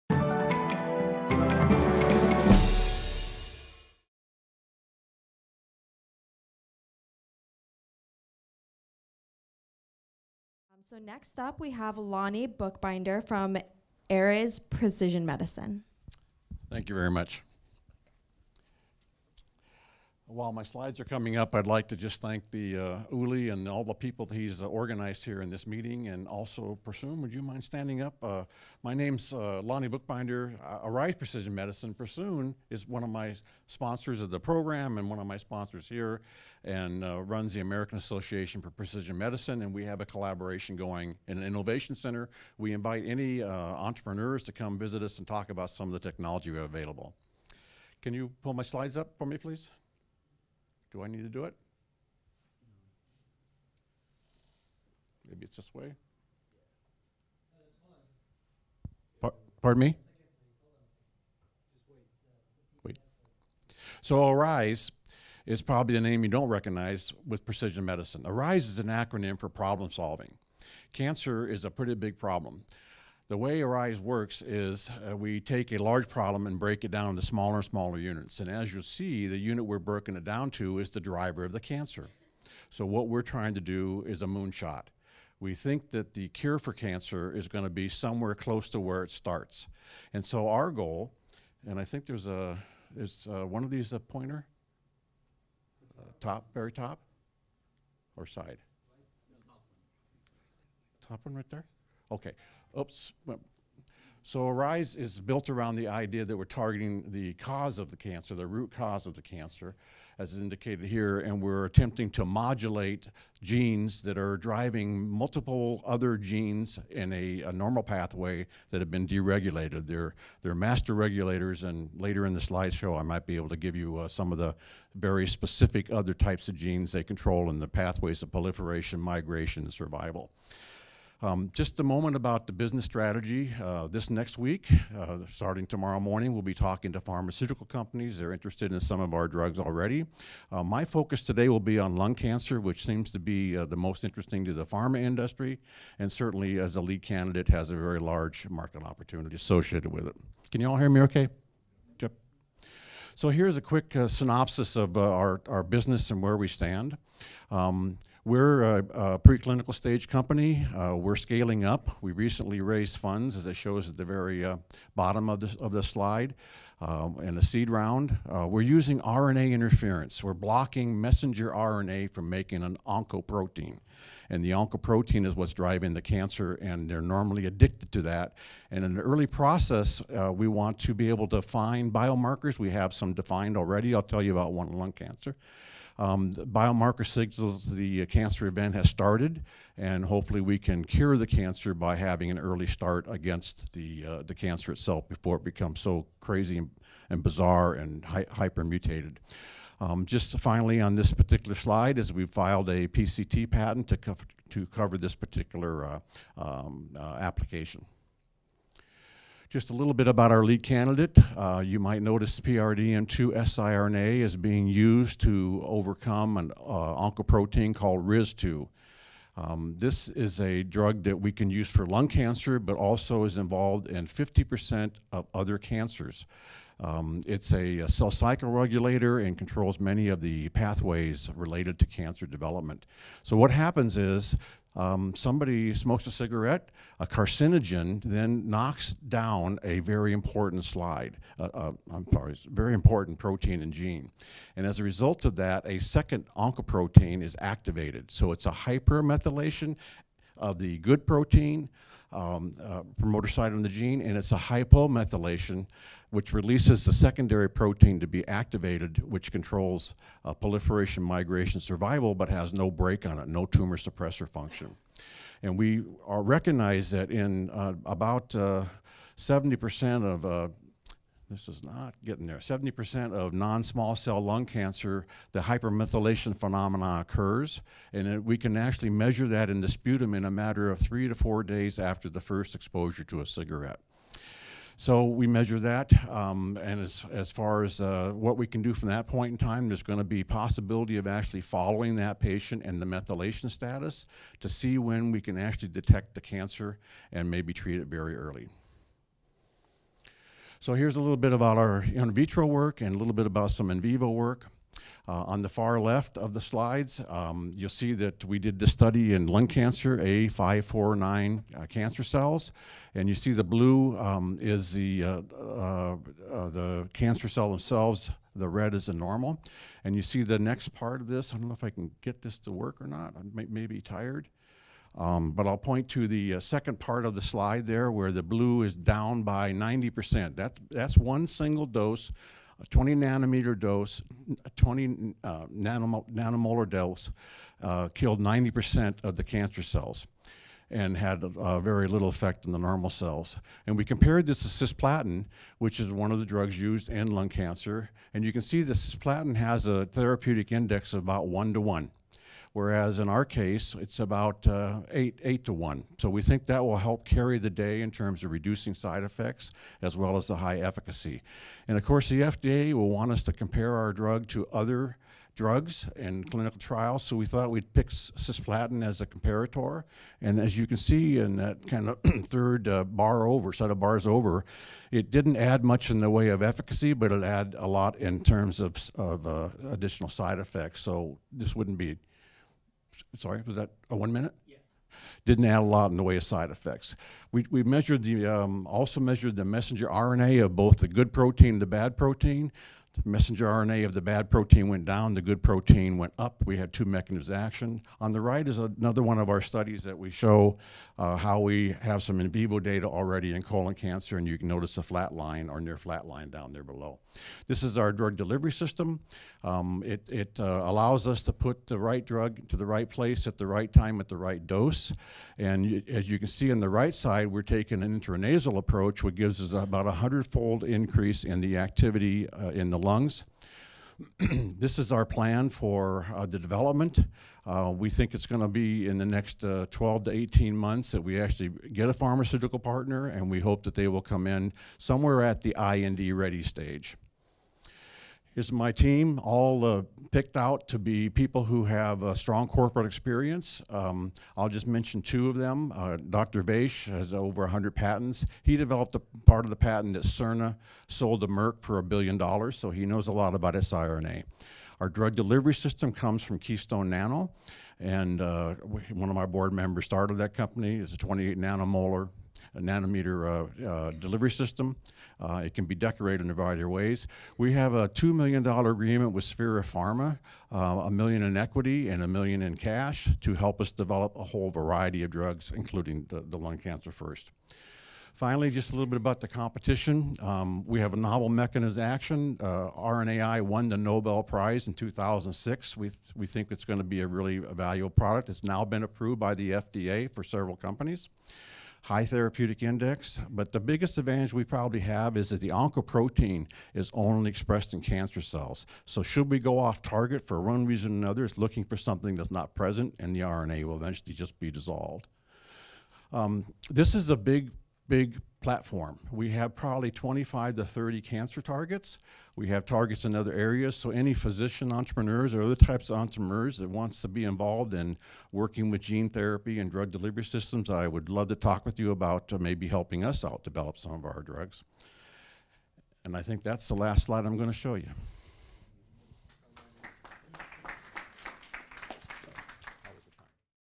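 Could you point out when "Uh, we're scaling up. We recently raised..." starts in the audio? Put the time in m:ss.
2:40.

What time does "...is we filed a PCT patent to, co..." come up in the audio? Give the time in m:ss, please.
3:21.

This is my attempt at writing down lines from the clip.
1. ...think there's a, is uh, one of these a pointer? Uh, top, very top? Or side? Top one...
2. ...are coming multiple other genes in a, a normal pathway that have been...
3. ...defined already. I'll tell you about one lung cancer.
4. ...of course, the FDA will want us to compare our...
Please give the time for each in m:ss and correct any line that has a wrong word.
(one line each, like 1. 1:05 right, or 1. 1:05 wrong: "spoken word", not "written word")
1. 1:31 right
2. 1:54 wrong: "driving", not "coming"
3. 3:03 right
4. 6:01 right.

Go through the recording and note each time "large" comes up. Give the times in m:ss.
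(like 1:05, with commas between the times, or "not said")
1:15, 2:27.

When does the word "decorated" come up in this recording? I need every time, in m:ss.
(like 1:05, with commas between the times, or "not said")
7:45.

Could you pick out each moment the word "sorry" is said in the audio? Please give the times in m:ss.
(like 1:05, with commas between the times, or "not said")
4:02, 6:23.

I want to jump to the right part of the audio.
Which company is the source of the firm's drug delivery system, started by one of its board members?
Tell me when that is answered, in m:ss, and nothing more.
7:36.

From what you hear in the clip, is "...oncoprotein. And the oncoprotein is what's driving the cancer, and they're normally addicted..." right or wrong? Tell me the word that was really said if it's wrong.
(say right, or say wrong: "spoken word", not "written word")
right.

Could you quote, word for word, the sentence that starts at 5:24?
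Um, but I'll point to the uh, second part of the slide there where the blue is down by 90%.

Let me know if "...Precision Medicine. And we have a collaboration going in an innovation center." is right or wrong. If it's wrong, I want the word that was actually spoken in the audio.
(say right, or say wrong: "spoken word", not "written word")
right.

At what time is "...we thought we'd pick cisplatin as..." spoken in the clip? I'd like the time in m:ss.
6:07.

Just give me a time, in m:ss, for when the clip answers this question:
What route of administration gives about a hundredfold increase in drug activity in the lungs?
6:57.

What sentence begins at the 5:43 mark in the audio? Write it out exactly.
And we compared this to cisplatin, which is one of the drugs used in lung cancer.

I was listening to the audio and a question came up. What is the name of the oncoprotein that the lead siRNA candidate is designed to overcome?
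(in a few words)
RIZ2.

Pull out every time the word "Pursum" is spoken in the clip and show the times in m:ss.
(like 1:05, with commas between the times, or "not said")
0:26, 0:31.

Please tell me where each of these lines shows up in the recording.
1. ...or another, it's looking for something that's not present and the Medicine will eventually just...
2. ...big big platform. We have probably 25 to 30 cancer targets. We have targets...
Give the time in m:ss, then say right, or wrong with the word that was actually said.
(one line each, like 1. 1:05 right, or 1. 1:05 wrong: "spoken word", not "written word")
1. 8:20 wrong: "RNA", not "Medicine"
2. 8:27 right.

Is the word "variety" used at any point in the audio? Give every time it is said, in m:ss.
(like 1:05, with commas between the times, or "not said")
7:46, 7:54.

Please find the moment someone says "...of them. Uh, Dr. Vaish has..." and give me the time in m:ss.
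7:25.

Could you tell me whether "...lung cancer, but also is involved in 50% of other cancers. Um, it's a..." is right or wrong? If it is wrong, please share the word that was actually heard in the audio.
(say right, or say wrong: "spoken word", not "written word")
right.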